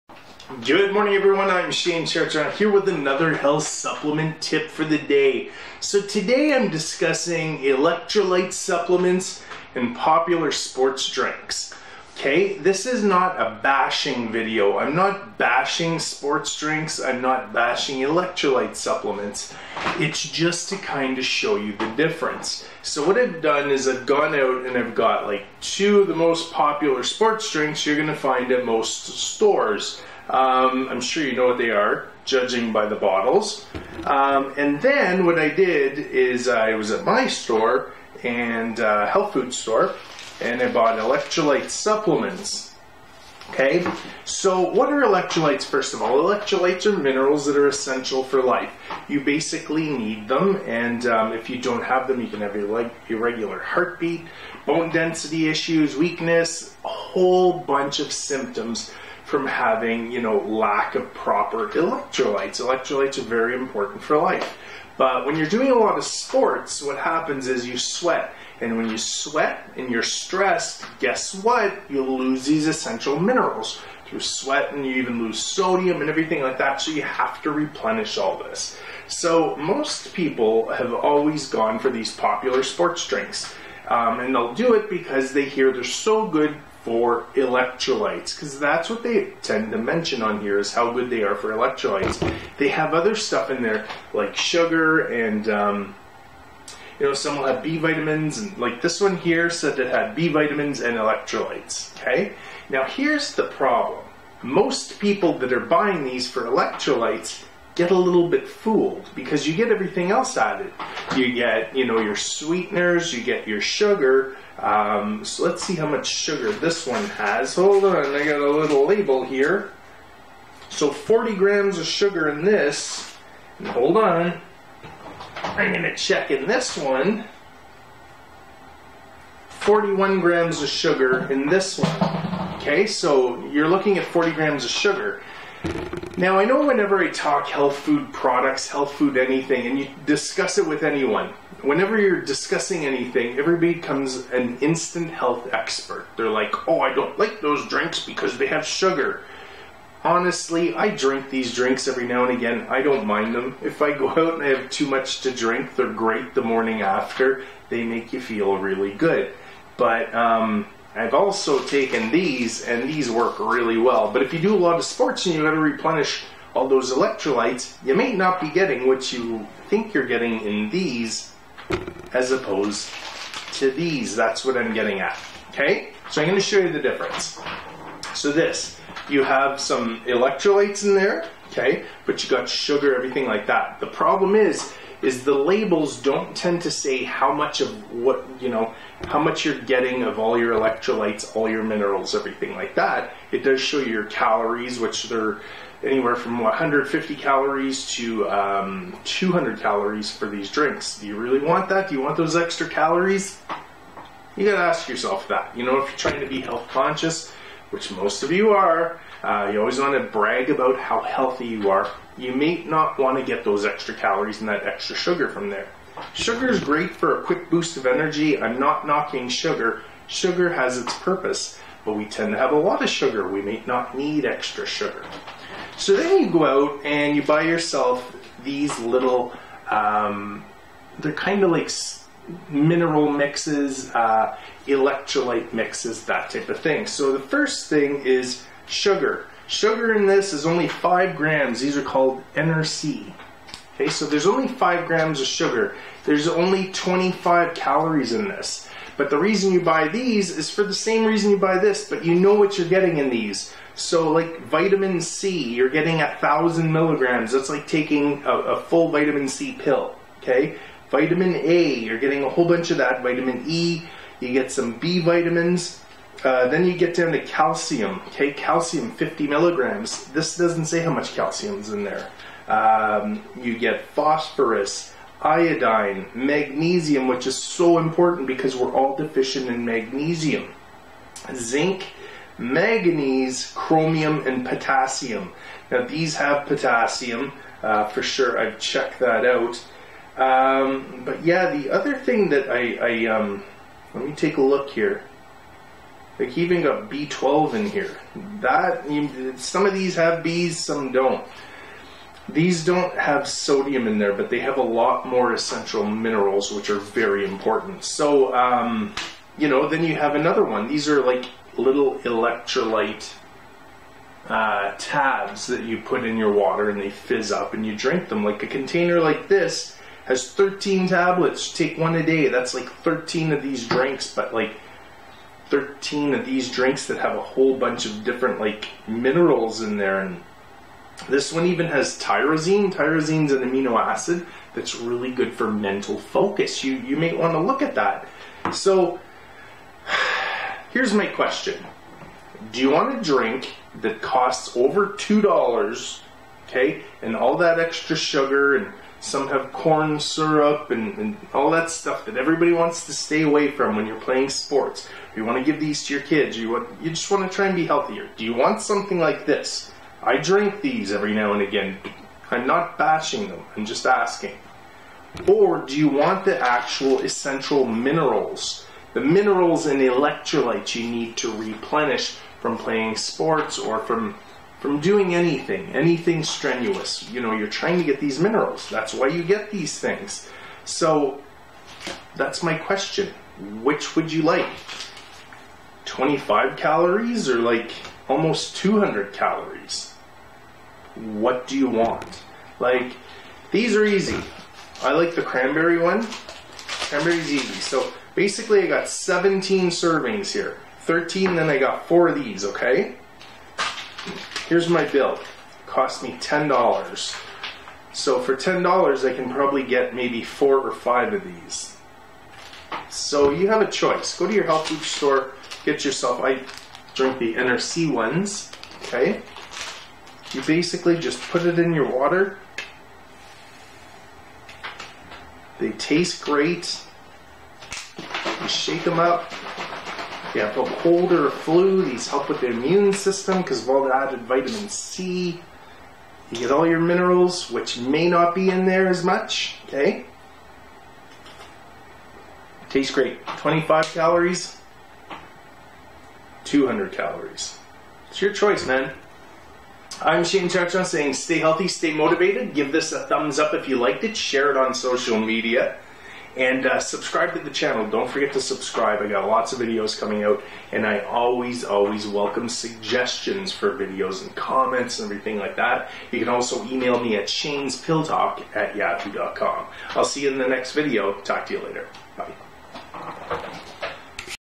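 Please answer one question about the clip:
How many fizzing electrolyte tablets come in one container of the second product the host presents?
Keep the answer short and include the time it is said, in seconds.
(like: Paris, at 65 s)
13, at 320 s.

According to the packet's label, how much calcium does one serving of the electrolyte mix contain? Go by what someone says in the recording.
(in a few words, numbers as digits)
50 milligrams.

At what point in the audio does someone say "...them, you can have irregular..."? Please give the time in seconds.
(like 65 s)
52 s.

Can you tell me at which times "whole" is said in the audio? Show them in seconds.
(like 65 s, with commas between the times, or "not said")
56 s, 262 s, 327 s.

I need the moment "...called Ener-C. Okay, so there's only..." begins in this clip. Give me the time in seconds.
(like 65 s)
241 s.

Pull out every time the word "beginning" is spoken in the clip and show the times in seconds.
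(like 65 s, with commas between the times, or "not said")
not said.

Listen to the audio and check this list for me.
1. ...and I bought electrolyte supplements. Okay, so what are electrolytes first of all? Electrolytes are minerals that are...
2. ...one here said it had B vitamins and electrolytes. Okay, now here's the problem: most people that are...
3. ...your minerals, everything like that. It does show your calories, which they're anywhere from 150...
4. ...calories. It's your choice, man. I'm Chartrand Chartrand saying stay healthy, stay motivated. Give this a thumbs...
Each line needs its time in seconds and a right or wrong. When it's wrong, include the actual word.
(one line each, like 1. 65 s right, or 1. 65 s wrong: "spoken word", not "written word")
1. 40 s right
2. 98 s right
3. 191 s right
4. 446 s wrong: "Shane", not "Chartrand".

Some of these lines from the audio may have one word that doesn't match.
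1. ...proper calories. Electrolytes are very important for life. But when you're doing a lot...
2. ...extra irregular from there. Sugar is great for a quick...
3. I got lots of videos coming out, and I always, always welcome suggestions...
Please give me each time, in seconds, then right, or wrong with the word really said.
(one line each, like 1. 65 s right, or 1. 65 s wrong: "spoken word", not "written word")
1. 61 s wrong: "electrolytes", not "calories"
2. 214 s wrong: "sugar", not "irregular"
3. 459 s right.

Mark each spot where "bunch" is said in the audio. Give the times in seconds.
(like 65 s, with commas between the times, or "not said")
57 s, 262 s, 327 s.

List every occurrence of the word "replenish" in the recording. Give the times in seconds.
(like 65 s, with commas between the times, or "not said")
77 s, 165 s, 371 s.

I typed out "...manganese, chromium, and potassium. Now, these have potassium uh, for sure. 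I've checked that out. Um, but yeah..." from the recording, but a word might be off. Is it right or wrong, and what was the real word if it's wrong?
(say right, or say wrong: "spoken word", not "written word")
right.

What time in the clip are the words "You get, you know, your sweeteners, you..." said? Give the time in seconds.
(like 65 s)
111 s.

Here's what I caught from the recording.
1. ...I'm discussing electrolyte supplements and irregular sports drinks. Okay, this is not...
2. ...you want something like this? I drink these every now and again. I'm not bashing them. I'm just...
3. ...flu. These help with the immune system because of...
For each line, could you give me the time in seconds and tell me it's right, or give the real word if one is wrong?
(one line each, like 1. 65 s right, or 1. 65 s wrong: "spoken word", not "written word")
1. 6 s wrong: "popular", not "irregular"
2. 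358 s right
3. 431 s right.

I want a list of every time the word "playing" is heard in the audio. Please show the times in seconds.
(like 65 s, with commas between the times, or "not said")
353 s, 372 s.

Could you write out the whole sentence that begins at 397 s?
So basically I got 17 servings here.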